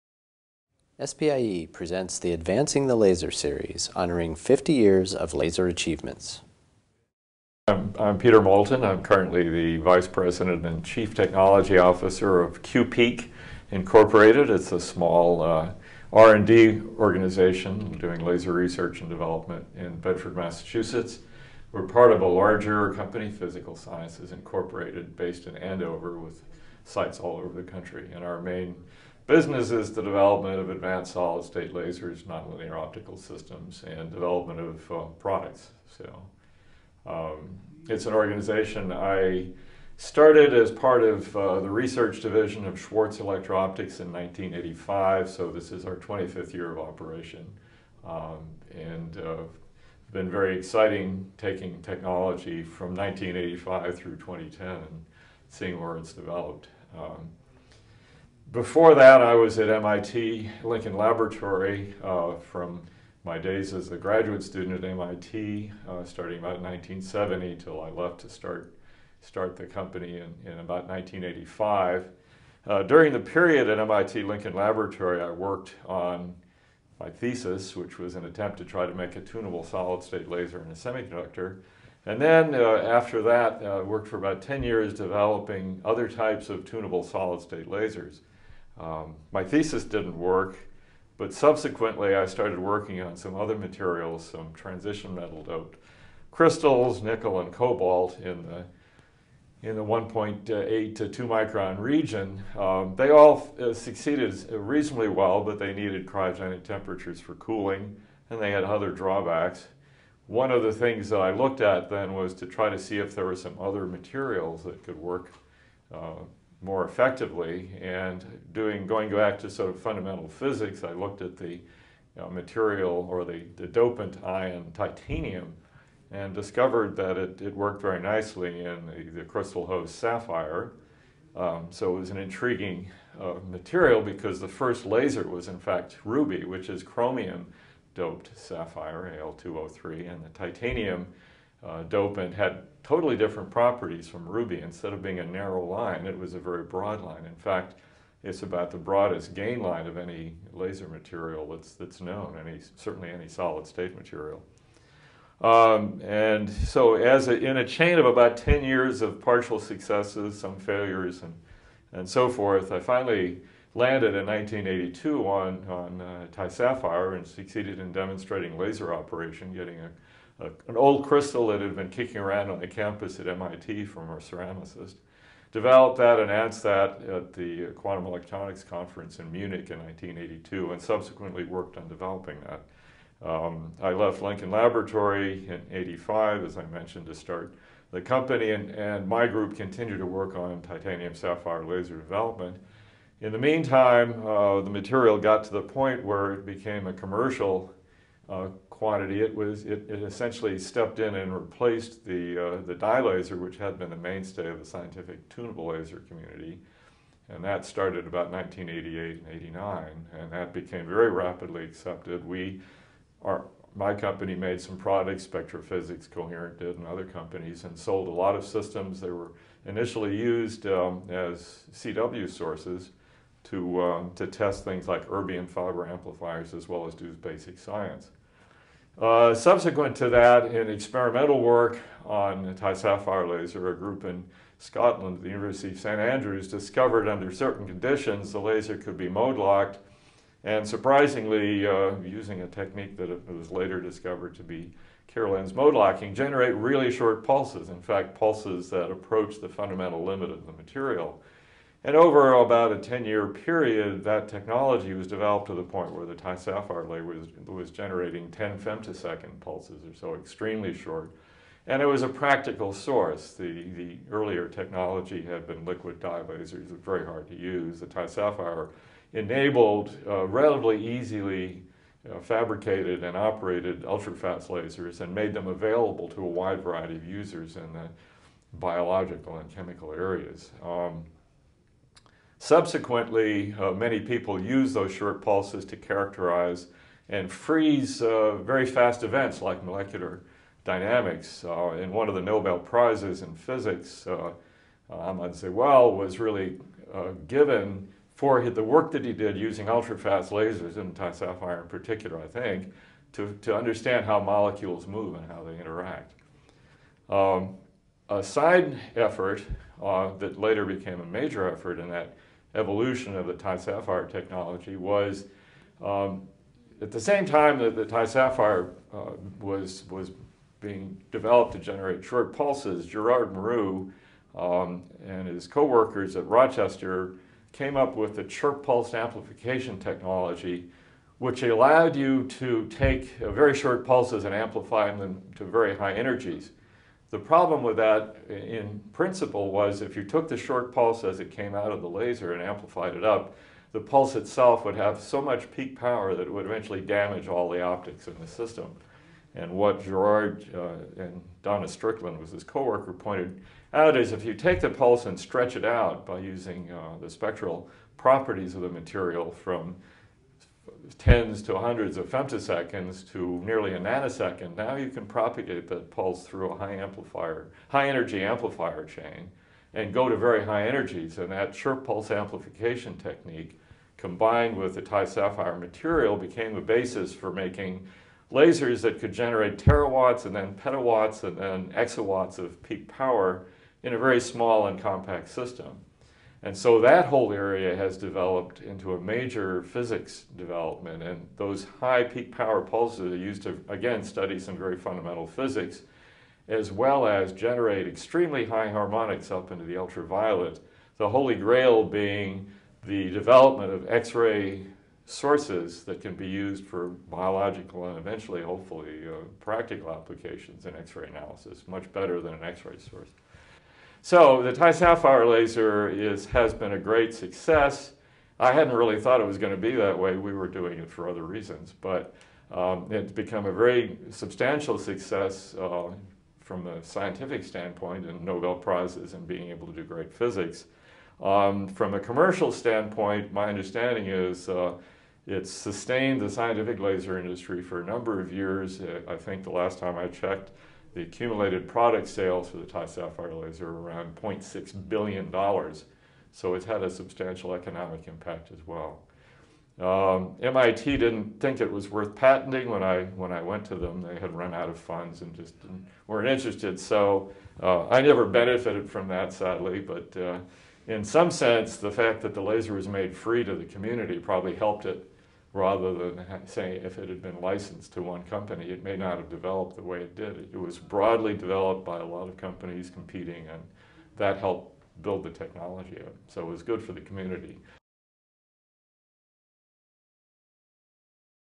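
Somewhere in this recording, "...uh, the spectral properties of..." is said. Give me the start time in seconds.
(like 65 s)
356 s.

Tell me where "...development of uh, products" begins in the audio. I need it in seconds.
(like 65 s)
34 s.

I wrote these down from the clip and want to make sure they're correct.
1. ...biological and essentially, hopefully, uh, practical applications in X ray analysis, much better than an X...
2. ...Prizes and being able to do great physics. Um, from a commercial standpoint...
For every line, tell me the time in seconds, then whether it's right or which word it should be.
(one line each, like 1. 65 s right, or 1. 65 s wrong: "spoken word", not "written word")
1. 406 s wrong: "eventually", not "essentially"
2. 428 s right.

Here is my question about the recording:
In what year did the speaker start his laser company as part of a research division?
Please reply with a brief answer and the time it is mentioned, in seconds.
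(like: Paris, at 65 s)
1985, at 44 s.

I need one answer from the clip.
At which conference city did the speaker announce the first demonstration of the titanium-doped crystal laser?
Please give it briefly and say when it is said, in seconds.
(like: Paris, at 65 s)
Munich, at 179 s.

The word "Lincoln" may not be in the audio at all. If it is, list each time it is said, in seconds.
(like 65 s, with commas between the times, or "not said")
60 s, 74 s, 184 s.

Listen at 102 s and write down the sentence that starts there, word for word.
Um, they all uh, succeeded reasonably well, but they needed cryogenic temperatures for cooling, and they had other drawbacks.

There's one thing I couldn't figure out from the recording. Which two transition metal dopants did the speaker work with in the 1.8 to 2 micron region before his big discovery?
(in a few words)
nickel and cobalt.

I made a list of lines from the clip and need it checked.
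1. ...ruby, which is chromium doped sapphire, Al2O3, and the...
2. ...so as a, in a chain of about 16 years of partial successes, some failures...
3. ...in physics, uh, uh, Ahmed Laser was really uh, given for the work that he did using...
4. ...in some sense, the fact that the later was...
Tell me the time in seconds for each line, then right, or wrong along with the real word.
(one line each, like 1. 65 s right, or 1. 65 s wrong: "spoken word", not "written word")
1. 136 s right
2. 156 s wrong: "10", not "16"
3. 293 s wrong: "Zewail", not "Laser"
4. 460 s wrong: "laser", not "later".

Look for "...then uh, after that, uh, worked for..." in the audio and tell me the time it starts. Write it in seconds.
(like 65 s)
82 s.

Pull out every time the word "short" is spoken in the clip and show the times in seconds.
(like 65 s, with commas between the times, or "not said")
246 s, 260 s, 284 s, 322 s, 333 s, 340 s, 371 s.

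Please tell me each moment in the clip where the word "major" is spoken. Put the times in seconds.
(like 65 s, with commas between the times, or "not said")
311 s, 388 s.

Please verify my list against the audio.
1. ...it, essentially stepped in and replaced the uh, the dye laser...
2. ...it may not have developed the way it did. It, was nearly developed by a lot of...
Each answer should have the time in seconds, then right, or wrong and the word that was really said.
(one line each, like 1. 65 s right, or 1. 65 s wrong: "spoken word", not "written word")
1. 199 s right
2. 468 s wrong: "broadly", not "nearly".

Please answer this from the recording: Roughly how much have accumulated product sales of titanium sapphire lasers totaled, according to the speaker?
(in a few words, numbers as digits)
$0.6 billion.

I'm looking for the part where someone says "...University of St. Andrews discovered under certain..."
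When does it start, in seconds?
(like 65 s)
235 s.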